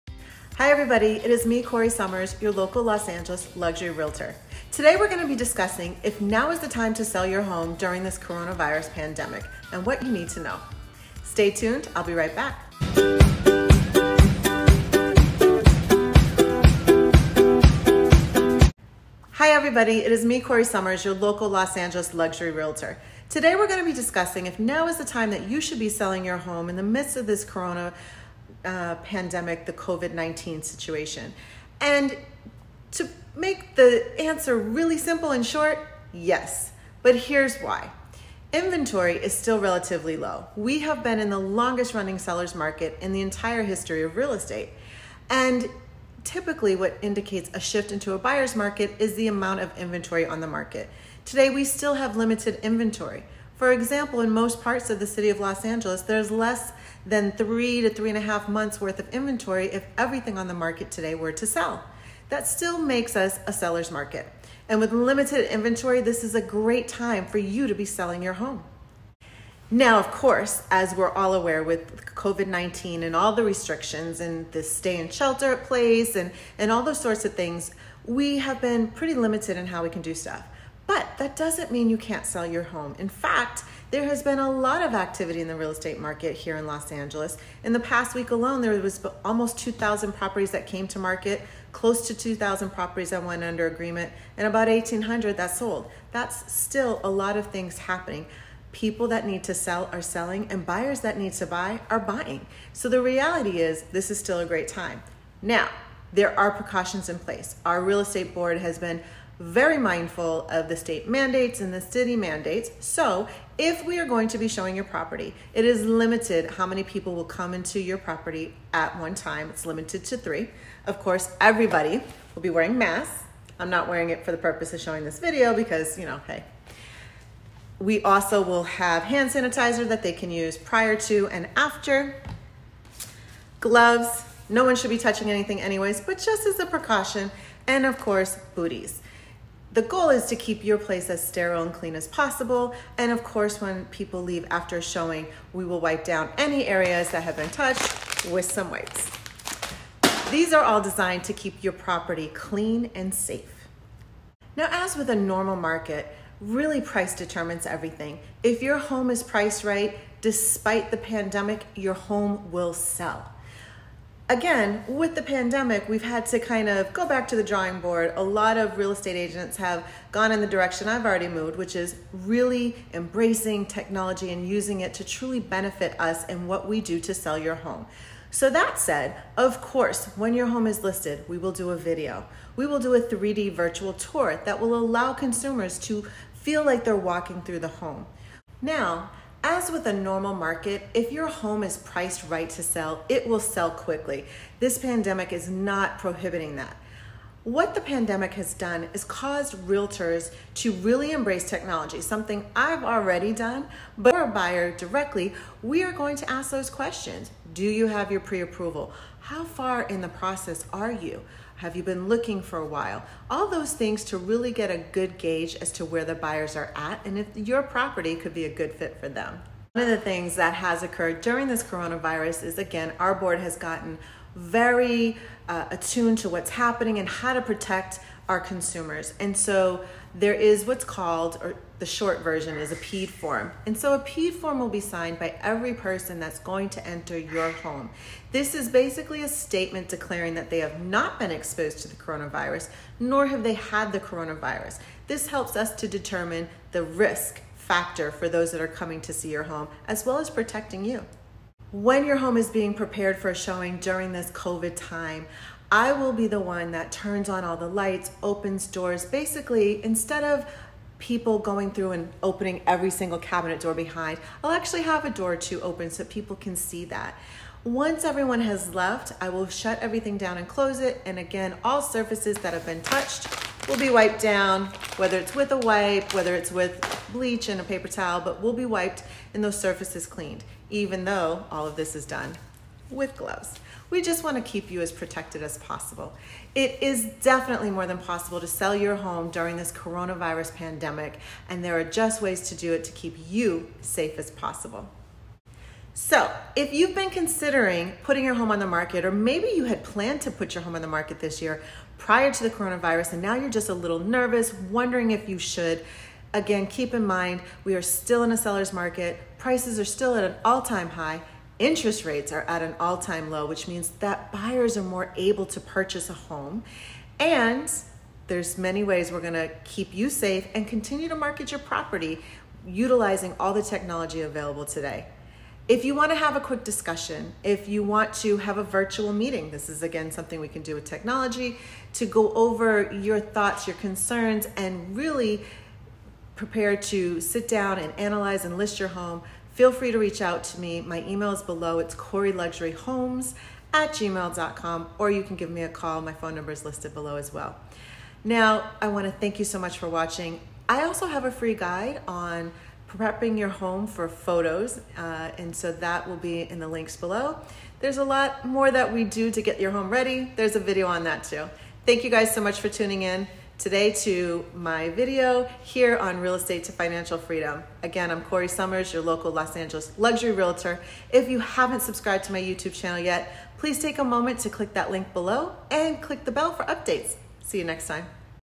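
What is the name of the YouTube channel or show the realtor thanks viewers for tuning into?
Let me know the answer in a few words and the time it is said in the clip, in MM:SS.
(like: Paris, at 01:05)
Real Estate to Financial Freedom, at 06:06.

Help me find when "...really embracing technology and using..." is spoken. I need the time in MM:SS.
02:52.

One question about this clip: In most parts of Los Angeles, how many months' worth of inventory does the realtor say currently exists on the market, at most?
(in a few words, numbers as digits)
3.5 months.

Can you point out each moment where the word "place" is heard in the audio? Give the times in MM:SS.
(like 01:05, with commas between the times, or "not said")
01:15, 01:47, 02:20.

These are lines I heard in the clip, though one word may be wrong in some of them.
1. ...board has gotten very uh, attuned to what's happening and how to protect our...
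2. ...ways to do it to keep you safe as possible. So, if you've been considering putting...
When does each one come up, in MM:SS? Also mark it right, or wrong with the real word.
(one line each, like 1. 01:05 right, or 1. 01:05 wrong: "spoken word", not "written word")
1. 03:43 right
2. 04:52 right.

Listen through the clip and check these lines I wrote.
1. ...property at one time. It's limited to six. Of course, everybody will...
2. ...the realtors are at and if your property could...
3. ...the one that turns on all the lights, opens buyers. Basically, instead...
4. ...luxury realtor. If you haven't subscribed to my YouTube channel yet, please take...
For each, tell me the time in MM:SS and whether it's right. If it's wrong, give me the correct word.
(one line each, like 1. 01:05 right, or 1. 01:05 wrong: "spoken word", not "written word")
1. 01:57 wrong: "three", not "six"
2. 03:36 wrong: "buyers", not "realtors"
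3. 04:16 wrong: "doors", not "buyers"
4. 06:09 right.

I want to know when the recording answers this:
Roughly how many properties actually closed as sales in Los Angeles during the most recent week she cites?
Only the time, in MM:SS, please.
01:34.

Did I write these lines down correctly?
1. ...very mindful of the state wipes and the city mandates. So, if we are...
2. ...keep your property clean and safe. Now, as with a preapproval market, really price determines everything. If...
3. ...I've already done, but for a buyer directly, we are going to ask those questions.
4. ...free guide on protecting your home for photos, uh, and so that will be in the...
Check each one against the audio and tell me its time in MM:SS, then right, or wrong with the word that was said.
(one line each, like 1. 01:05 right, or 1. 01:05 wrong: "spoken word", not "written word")
1. 01:49 wrong: "mandates", not "wipes"
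2. 02:31 wrong: "normal", not "preapproval"
3. 03:22 right
4. 05:51 wrong: "prepping", not "protecting".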